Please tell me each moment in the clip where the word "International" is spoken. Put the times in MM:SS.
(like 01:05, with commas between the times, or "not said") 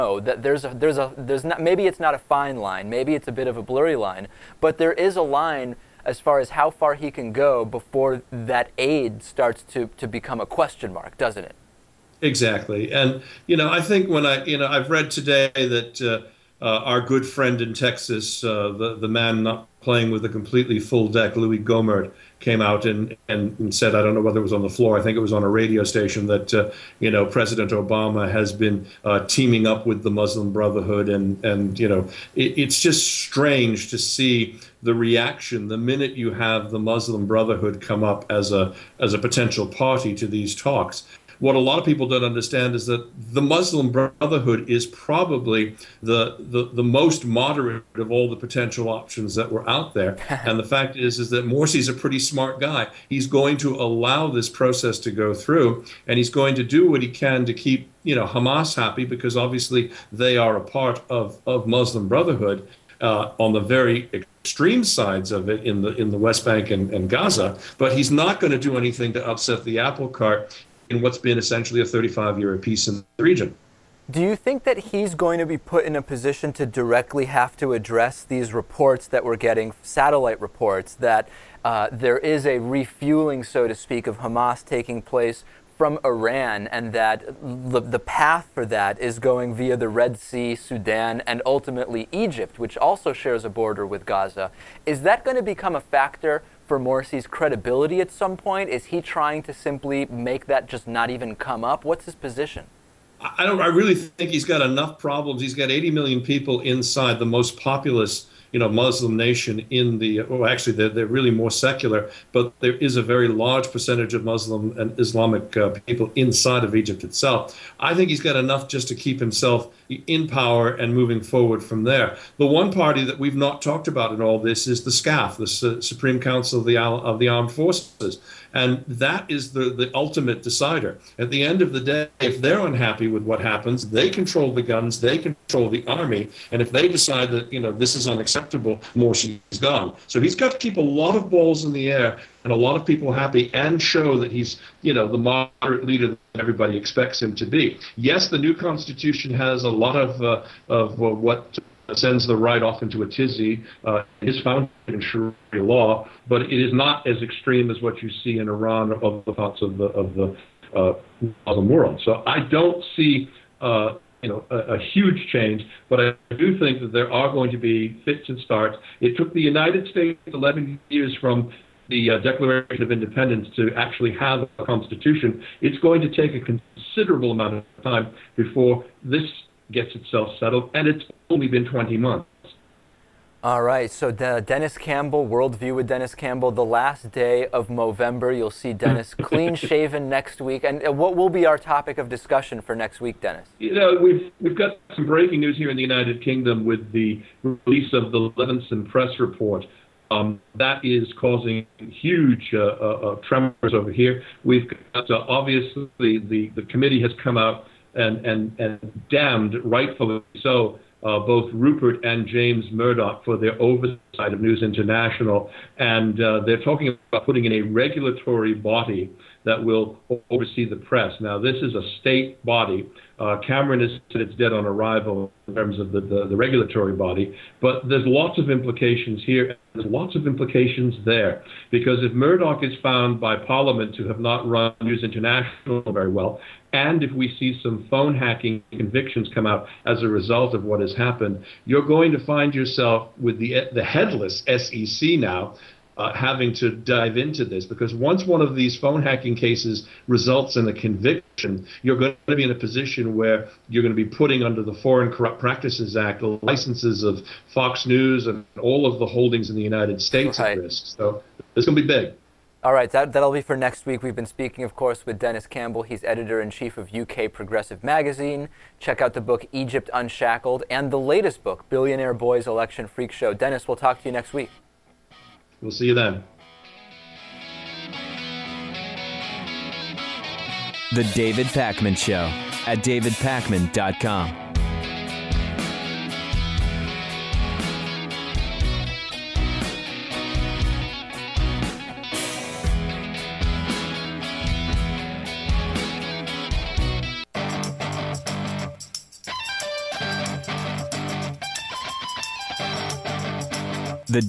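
03:34, 03:55.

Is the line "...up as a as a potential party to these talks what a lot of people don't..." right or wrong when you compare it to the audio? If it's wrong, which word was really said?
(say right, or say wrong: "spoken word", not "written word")
right.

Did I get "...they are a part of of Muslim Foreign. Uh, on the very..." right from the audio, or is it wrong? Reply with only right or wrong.
wrong.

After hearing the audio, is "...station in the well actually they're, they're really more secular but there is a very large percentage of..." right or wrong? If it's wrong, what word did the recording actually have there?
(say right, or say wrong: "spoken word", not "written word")
wrong: "nation", not "station".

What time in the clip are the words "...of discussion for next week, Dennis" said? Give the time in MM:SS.
03:11.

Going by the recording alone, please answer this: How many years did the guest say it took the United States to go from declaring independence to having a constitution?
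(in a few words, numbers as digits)
11.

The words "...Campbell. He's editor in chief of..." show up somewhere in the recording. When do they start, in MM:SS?
04:25.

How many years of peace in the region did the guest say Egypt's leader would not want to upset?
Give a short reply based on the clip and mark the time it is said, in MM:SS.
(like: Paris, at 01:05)
35, at 01:11.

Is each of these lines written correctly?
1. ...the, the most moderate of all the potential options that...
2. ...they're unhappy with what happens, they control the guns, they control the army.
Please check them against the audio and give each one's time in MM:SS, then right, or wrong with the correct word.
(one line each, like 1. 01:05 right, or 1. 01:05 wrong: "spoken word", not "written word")
1. 00:46 right
2. 02:12 right.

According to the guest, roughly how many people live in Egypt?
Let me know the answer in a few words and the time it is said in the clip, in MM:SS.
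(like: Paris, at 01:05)
80 million, at 01:45.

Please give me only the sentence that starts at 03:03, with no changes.
All right, so De Dennis Campbell, Worldview with Dennis Campbell, the last day of November.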